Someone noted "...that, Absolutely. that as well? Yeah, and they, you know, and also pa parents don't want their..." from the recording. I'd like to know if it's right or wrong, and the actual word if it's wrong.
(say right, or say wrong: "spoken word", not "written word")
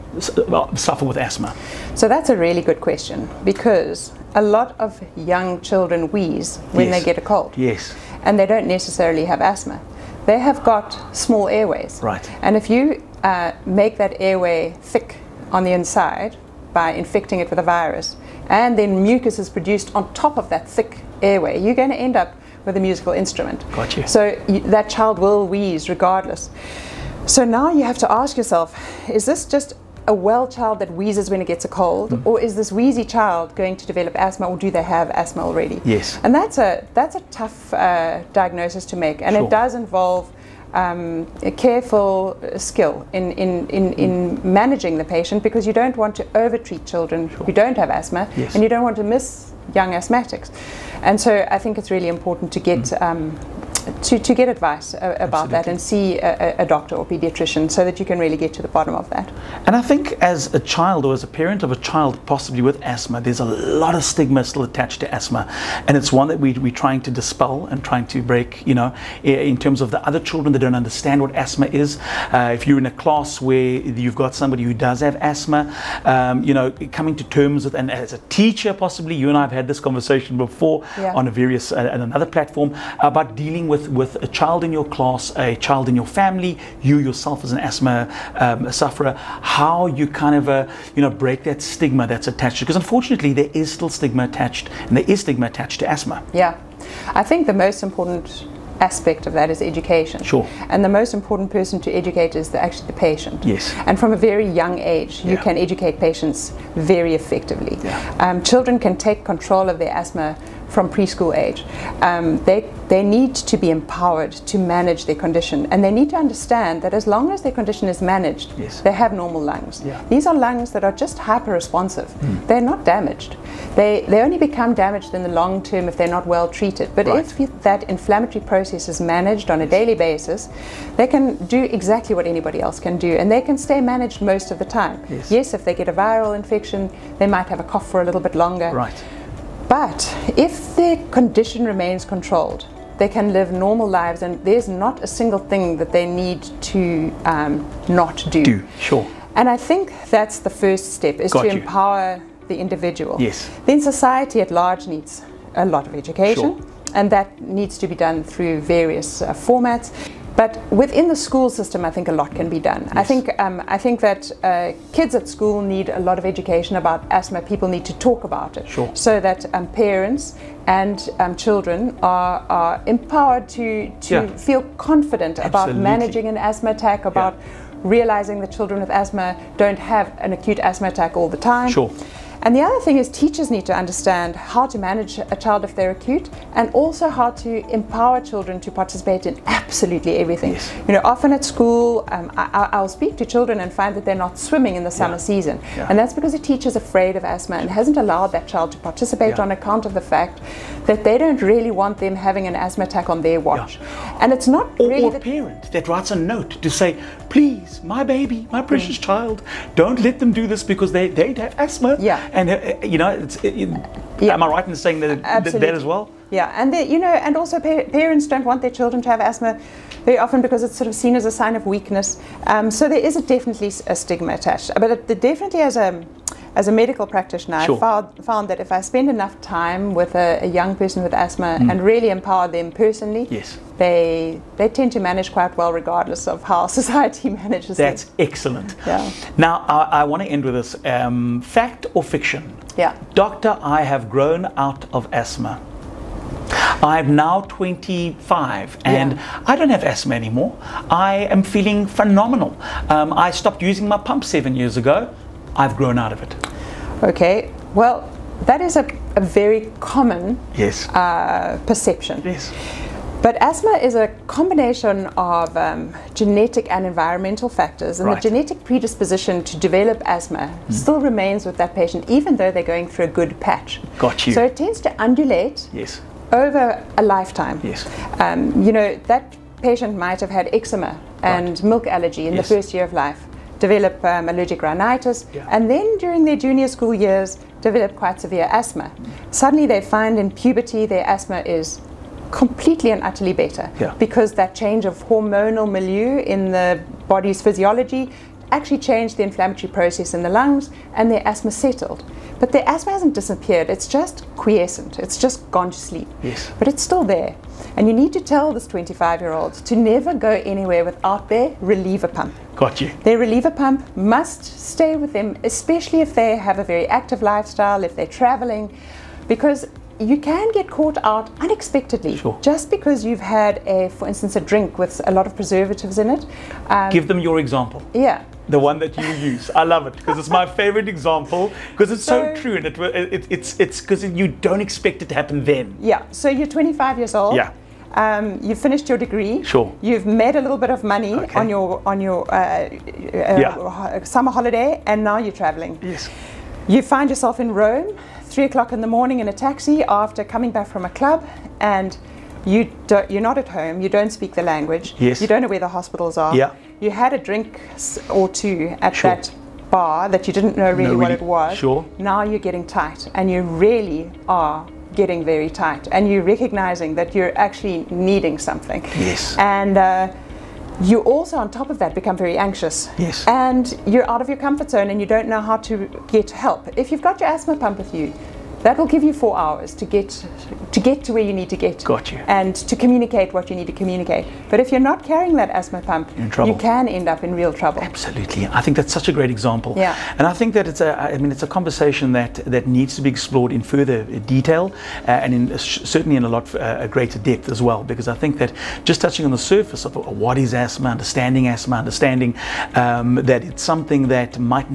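right.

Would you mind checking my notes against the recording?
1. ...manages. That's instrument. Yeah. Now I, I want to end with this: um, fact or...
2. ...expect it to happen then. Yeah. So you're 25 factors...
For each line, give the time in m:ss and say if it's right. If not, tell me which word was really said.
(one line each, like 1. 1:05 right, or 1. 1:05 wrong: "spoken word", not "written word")
1. 3:57 wrong: "excellent", not "instrument"
2. 5:34 wrong: "years", not "factors".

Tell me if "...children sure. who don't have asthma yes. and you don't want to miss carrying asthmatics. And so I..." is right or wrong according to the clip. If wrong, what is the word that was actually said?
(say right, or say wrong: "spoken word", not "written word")
wrong: "young", not "carrying".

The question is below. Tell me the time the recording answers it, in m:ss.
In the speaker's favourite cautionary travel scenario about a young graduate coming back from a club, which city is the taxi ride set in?
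5:47.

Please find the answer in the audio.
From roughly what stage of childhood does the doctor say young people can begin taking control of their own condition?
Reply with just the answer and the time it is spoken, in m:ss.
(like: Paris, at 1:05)
Preschool age, at 1:50.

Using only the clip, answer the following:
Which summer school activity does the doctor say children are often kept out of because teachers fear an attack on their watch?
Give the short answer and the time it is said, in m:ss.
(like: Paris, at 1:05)
Swimming, at 3:14.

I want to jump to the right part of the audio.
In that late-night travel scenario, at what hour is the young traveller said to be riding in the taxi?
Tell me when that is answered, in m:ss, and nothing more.
5:48.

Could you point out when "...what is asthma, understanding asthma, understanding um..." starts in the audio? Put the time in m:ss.
6:39.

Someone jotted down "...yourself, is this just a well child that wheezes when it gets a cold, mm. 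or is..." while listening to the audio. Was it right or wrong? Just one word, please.
right.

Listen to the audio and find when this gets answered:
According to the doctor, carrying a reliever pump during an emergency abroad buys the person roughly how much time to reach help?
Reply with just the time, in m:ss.
6:19.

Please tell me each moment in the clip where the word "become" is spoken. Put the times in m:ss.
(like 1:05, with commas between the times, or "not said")
2:04, 6:11.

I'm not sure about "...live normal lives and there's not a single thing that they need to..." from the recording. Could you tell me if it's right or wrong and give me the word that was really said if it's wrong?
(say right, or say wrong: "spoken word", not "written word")
right.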